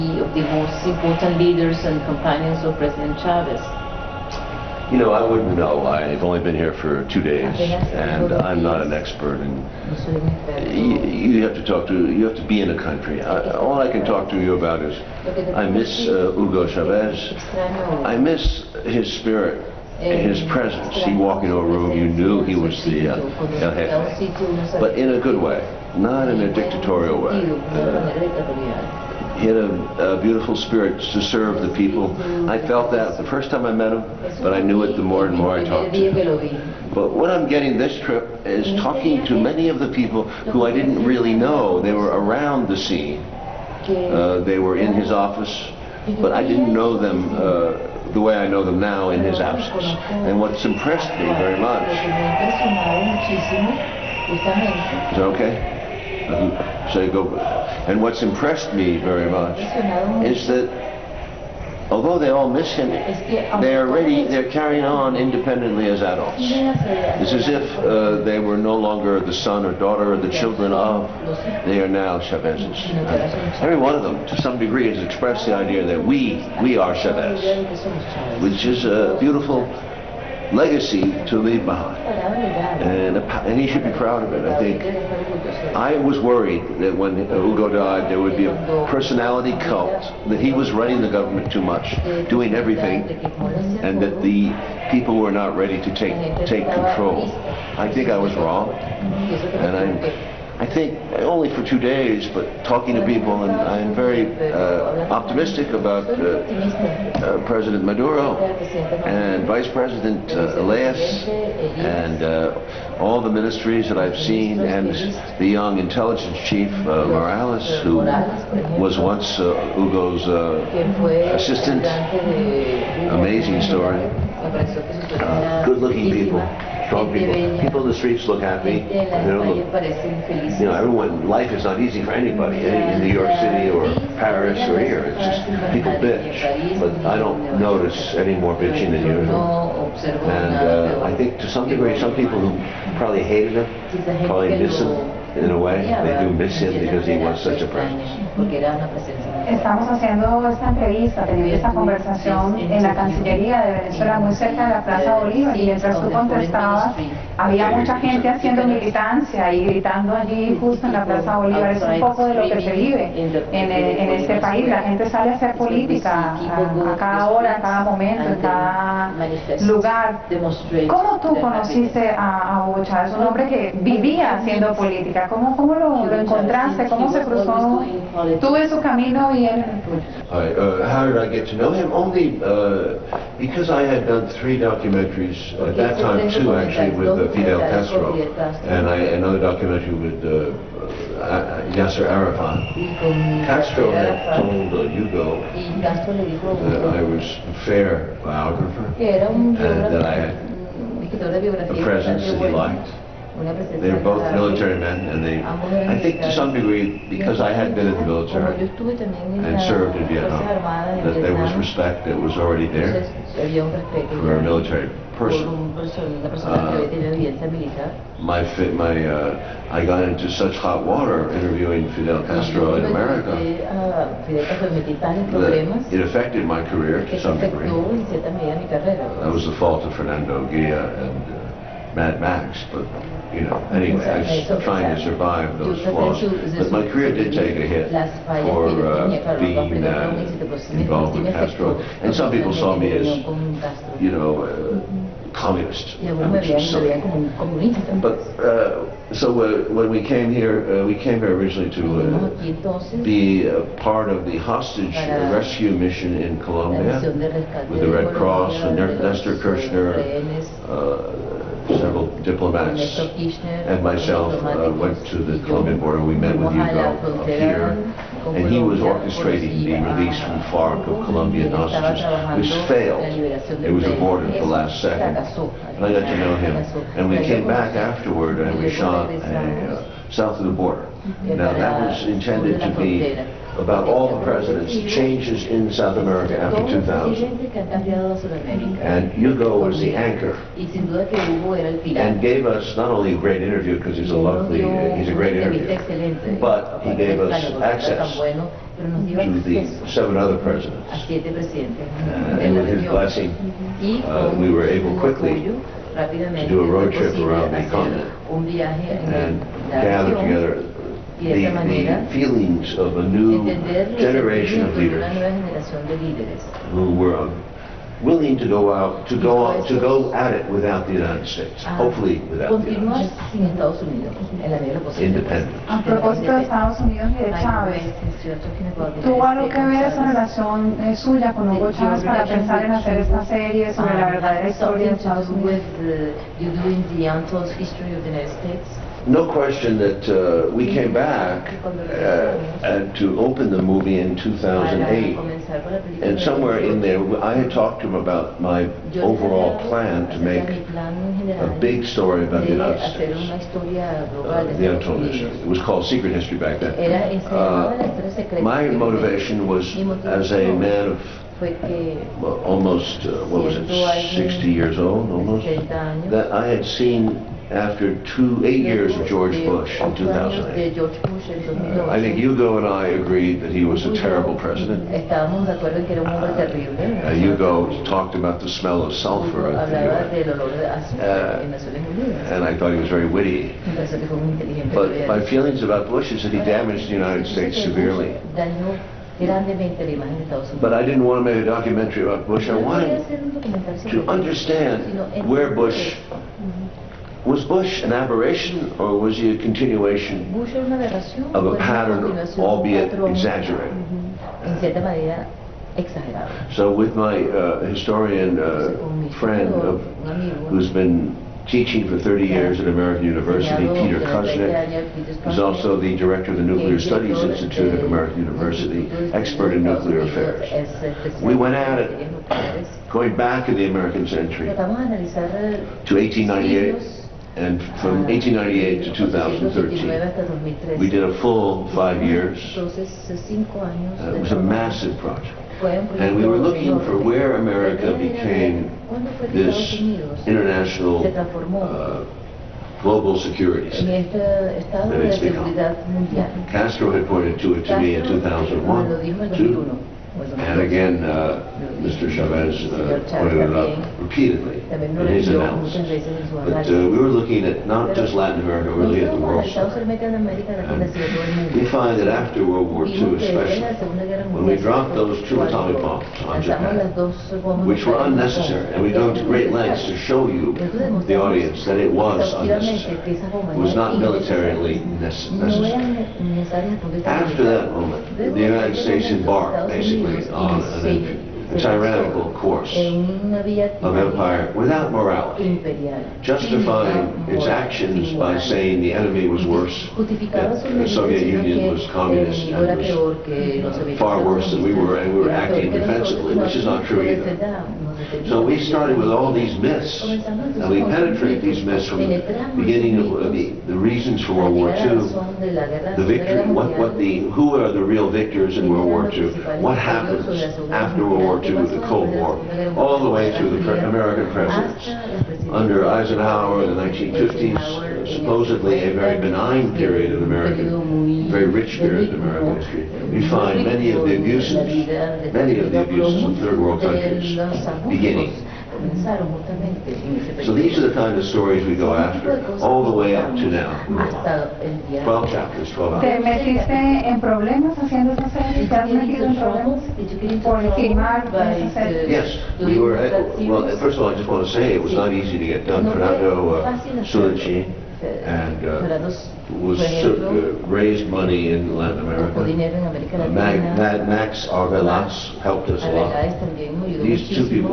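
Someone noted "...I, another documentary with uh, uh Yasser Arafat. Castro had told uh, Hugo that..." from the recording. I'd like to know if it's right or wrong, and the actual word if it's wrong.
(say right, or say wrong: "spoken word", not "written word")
right.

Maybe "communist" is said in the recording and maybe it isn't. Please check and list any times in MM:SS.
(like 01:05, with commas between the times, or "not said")
04:05, 08:11.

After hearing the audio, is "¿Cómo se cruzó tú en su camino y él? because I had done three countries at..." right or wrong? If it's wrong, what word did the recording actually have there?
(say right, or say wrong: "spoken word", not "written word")
wrong: "documentaries", not "countries".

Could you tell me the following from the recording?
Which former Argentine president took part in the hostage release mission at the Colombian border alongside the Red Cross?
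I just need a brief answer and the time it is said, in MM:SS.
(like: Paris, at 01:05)
Nestor Kirchner, at 04:18.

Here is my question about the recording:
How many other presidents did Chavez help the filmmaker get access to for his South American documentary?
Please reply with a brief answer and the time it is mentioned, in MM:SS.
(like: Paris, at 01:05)
7, at 04:59.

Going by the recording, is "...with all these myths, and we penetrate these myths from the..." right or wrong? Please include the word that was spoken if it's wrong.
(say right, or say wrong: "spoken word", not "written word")
right.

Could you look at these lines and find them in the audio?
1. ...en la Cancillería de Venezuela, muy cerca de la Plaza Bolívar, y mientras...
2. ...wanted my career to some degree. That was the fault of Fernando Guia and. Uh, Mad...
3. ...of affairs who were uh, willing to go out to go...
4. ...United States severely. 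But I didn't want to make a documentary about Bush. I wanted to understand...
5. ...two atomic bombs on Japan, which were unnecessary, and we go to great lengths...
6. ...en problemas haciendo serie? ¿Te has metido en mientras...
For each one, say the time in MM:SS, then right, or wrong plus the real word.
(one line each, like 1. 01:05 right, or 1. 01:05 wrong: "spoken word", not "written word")
1. 02:32 right
2. 03:46 wrong: "affected", not "wanted"
3. 05:14 wrong: "leaders", not "affairs"
4. 06:26 right
5. 07:45 right
6. 08:57 wrong: "problemas", not "mientras".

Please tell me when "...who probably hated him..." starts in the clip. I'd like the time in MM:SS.
02:22.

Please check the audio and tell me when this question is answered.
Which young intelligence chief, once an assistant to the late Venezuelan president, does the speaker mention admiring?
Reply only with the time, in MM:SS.
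01:57.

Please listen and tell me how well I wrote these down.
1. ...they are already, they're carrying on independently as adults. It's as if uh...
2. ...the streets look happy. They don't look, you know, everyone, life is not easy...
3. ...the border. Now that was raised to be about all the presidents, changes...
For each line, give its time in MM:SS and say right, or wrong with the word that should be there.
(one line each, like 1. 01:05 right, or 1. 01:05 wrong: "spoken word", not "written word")
1. 01:03 right
2. 02:07 right
3. 04:40 wrong: "intended", not "raised".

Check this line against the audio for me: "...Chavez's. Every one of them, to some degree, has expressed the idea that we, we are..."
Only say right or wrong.
right.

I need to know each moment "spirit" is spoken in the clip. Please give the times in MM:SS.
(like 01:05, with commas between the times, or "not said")
00:19, 00:30.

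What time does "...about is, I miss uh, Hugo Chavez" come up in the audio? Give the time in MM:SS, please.
00:14.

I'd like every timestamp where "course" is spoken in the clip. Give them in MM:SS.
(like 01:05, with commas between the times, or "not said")
08:02.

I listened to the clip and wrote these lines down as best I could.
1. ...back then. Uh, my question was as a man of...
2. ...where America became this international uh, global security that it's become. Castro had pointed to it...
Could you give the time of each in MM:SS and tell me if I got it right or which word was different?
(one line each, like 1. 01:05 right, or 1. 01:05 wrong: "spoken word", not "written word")
1. 05:56 wrong: "motivation", not "question"
2. 07:16 right.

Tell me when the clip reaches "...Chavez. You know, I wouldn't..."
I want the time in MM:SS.
00:03.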